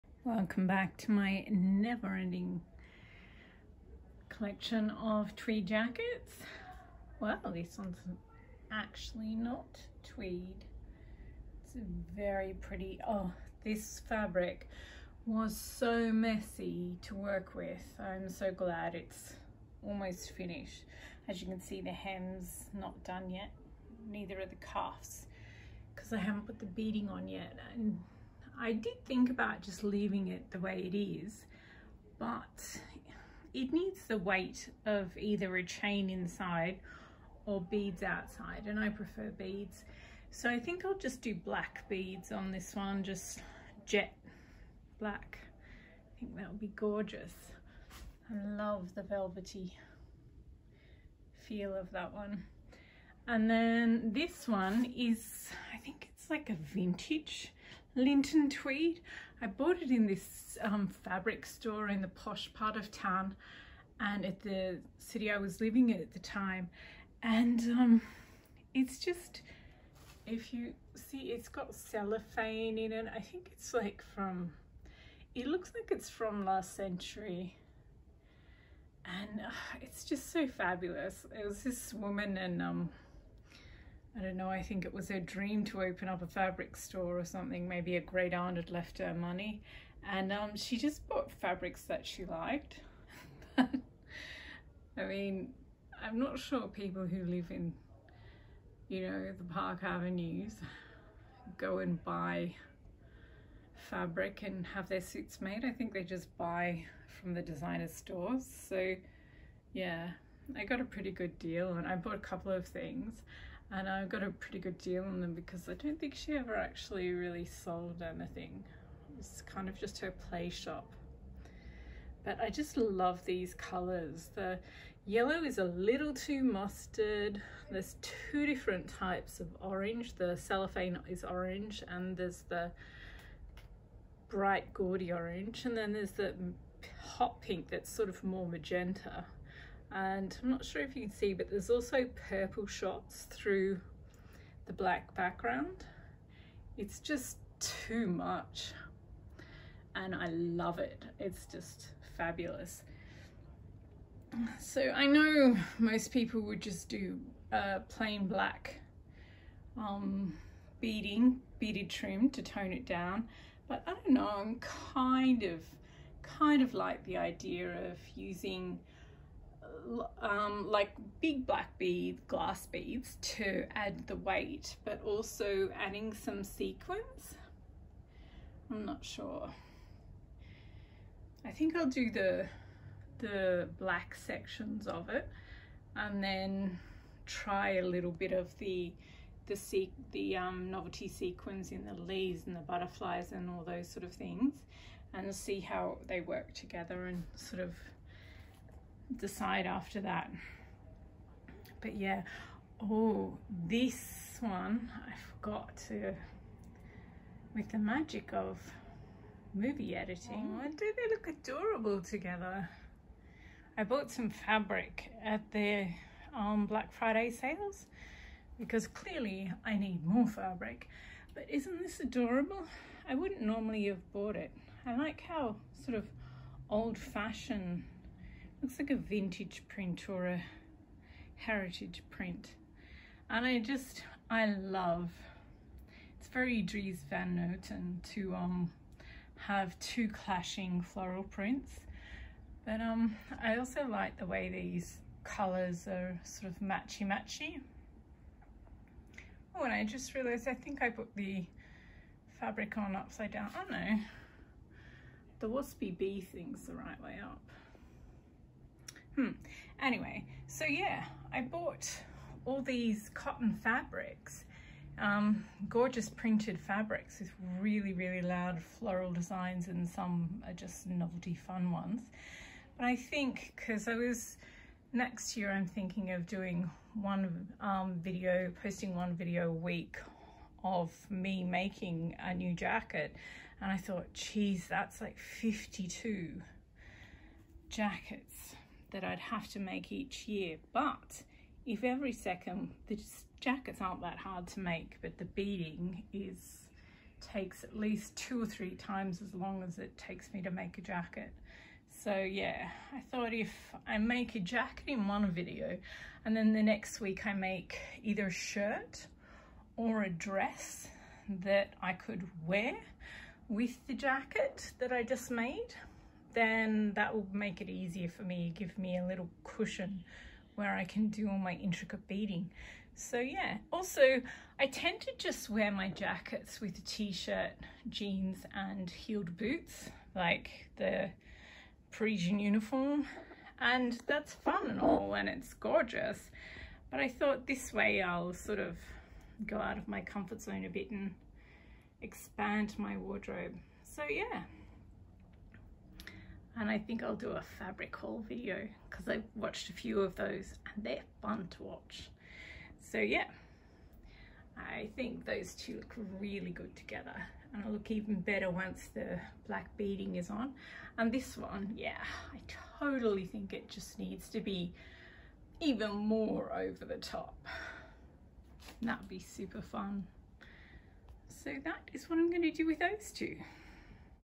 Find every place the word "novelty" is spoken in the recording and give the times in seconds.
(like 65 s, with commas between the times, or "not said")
190 s, 270 s.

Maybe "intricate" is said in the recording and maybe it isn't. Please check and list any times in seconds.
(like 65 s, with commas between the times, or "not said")
321 s.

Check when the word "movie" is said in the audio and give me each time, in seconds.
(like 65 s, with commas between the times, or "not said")
209 s.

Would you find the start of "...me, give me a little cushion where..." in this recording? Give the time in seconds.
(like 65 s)
318 s.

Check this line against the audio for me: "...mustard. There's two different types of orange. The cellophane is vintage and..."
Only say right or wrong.
wrong.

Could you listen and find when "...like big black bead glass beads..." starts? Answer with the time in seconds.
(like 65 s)
170 s.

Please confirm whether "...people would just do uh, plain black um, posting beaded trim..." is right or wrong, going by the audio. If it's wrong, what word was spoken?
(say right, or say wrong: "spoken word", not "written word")
wrong: "beading", not "posting".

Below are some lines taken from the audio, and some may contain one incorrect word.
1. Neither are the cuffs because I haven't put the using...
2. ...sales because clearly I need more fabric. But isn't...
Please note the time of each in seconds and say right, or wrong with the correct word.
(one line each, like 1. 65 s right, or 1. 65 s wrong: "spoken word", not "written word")
1. 24 s wrong: "beading", not "using"
2. 217 s right.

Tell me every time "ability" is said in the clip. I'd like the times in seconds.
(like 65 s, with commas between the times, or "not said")
not said.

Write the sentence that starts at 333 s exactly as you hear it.
And that's fun and all, and it's gorgeous.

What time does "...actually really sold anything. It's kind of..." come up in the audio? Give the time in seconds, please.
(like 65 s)
116 s.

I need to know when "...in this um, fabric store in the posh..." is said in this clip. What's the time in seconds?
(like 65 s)
59 s.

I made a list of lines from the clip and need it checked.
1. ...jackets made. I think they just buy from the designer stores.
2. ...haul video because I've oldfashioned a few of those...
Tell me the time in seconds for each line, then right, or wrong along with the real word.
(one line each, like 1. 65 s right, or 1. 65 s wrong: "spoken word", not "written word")
1. 105 s wrong: "suits", not "jackets"
2. 347 s wrong: "watched", not "oldfashioned".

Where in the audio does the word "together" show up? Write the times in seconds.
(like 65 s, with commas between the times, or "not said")
196 s, 212 s, 356 s.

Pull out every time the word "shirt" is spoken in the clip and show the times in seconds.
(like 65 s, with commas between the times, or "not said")
308 s, 326 s.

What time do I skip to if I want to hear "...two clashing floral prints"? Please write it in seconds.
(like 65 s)
239 s.